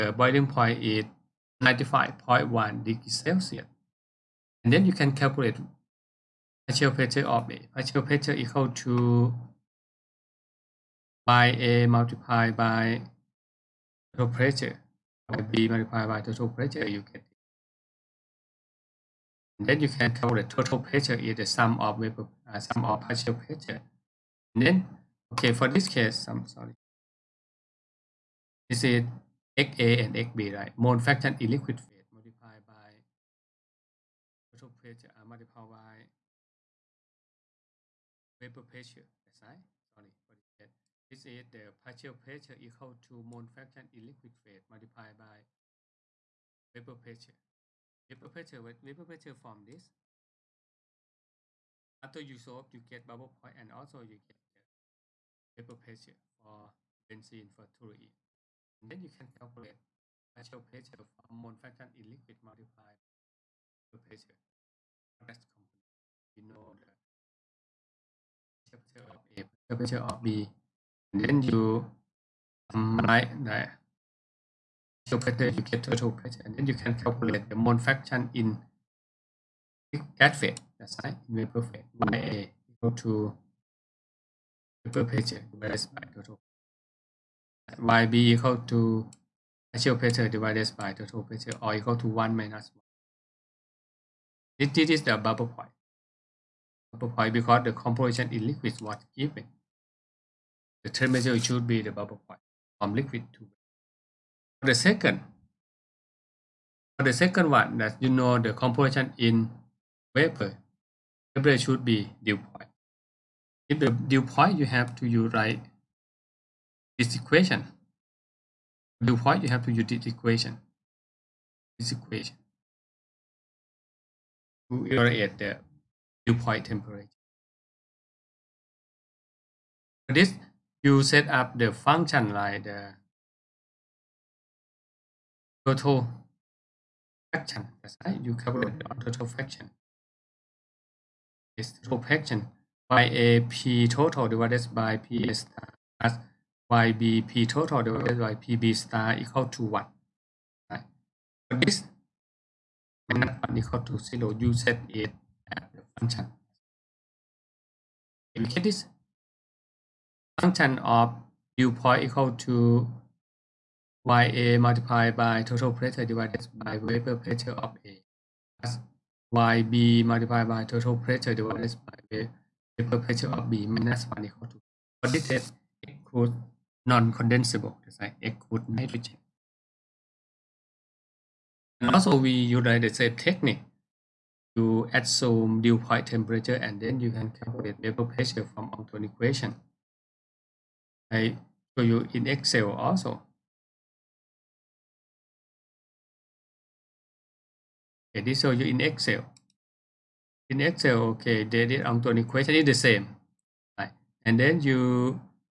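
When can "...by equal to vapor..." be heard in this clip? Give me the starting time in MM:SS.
01:21.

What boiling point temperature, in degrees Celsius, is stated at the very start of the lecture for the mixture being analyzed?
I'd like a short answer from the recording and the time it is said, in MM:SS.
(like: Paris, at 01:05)
95.1, at 00:01.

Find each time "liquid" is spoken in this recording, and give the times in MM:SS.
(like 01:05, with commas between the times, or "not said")
00:31, 00:44, 01:02, 01:38, 01:42.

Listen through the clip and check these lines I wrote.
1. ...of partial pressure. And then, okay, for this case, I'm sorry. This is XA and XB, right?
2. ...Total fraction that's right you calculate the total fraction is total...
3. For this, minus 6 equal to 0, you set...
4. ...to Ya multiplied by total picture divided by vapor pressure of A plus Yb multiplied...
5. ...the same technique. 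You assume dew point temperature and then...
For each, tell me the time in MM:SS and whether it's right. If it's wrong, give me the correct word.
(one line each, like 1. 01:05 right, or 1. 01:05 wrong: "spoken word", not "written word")
1. 00:22 wrong: "picture", not "pressure"
2. 02:15 right
3. 02:31 wrong: "1", not "6"
4. 02:42 wrong: "pressure", not "picture"
5. 03:02 right.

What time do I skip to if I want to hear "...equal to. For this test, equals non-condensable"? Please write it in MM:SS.
02:54.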